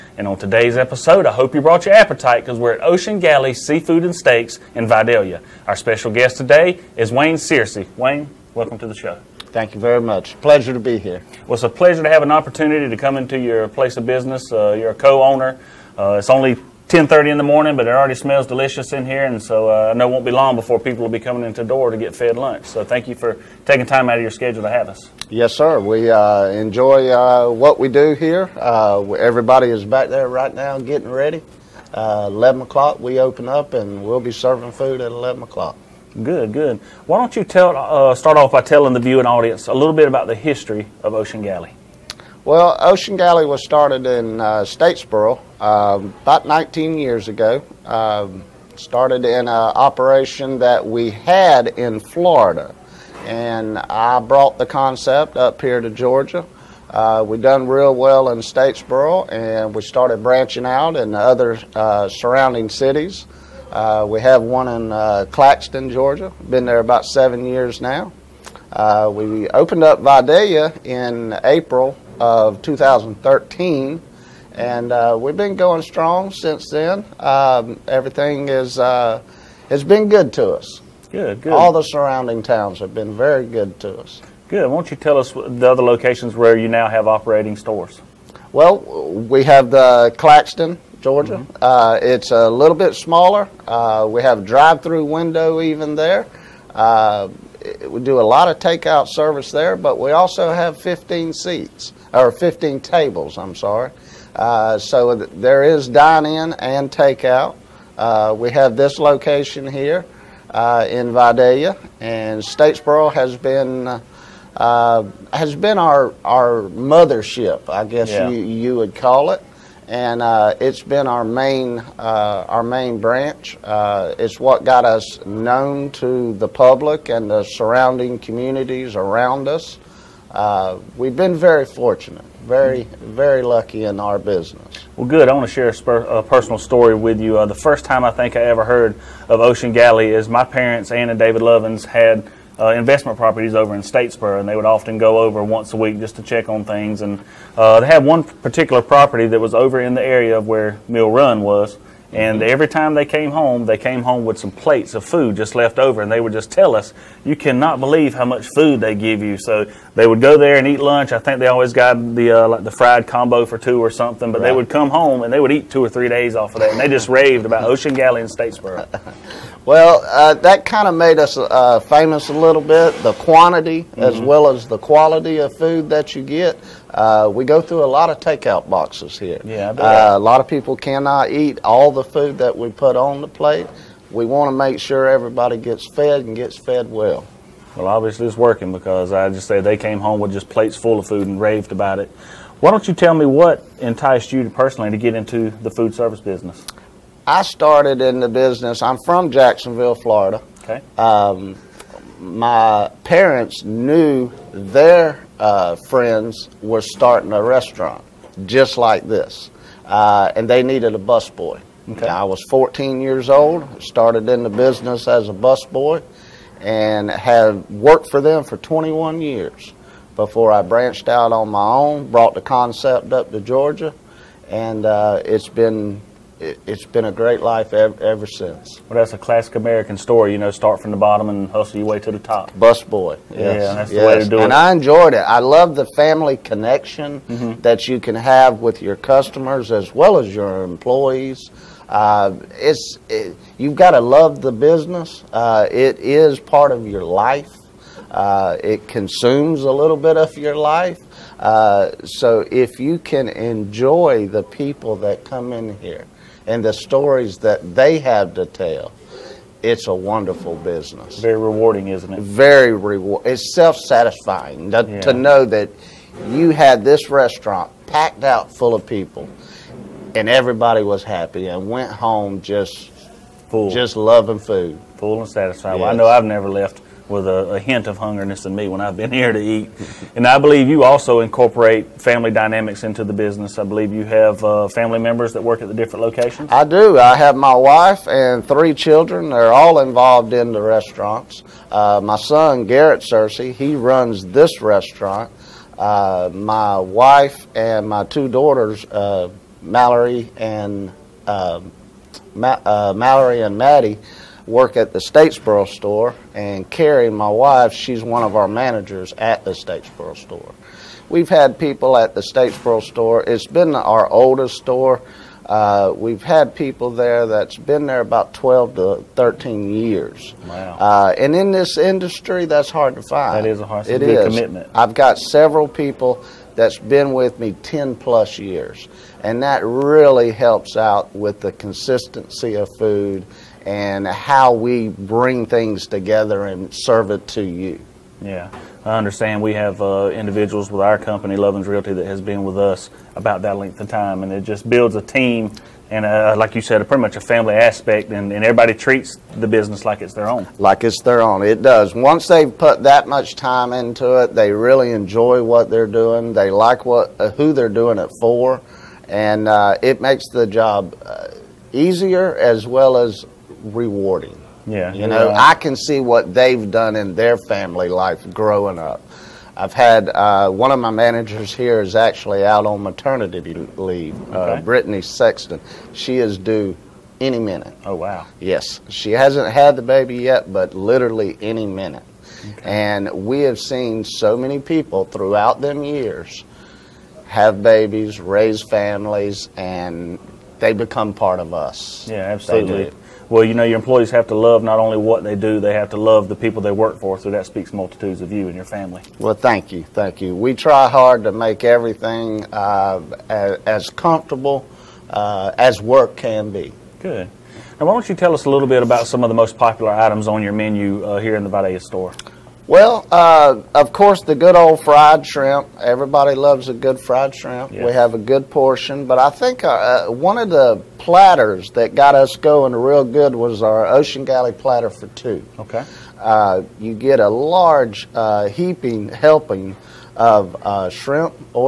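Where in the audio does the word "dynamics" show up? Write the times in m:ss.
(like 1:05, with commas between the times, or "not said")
4:42.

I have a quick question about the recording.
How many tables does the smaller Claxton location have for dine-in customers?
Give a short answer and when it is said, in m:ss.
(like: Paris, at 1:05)
15, at 1:42.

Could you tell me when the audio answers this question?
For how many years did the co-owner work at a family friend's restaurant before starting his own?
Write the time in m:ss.
3:38.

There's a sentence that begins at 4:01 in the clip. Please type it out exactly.
Uh, it's it, you've got to love the business.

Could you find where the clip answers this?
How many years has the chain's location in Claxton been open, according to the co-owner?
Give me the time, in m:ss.
1:07.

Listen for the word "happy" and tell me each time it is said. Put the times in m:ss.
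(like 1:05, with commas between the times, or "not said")
4:31.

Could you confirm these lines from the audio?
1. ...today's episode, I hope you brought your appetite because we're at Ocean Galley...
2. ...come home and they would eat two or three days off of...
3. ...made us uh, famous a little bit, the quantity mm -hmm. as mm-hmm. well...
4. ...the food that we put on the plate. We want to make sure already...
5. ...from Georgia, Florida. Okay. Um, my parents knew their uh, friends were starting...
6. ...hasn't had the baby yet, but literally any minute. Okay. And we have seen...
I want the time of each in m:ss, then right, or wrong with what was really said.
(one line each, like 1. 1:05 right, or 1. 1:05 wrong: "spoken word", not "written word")
1. 0:00 right
2. 2:44 right
3. 2:50 right
4. 3:01 wrong: "everybody", not "already"
5. 3:19 wrong: "Jacksonville", not "Georgia"
6. 6:19 right.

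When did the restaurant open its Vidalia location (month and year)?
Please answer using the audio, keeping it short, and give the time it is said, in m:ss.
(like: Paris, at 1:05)
April 2013, at 1:11.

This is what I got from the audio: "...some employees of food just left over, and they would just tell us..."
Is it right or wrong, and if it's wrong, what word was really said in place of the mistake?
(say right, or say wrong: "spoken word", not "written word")
wrong: "plates", not "employees".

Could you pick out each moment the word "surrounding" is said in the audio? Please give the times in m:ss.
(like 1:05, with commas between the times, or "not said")
1:02, 1:21, 2:07.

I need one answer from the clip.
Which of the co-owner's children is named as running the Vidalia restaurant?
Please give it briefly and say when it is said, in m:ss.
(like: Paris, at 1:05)
Garrett Searcy, at 4:52.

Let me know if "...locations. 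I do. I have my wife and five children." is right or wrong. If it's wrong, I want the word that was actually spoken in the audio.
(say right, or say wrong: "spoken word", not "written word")
wrong: "three", not "five".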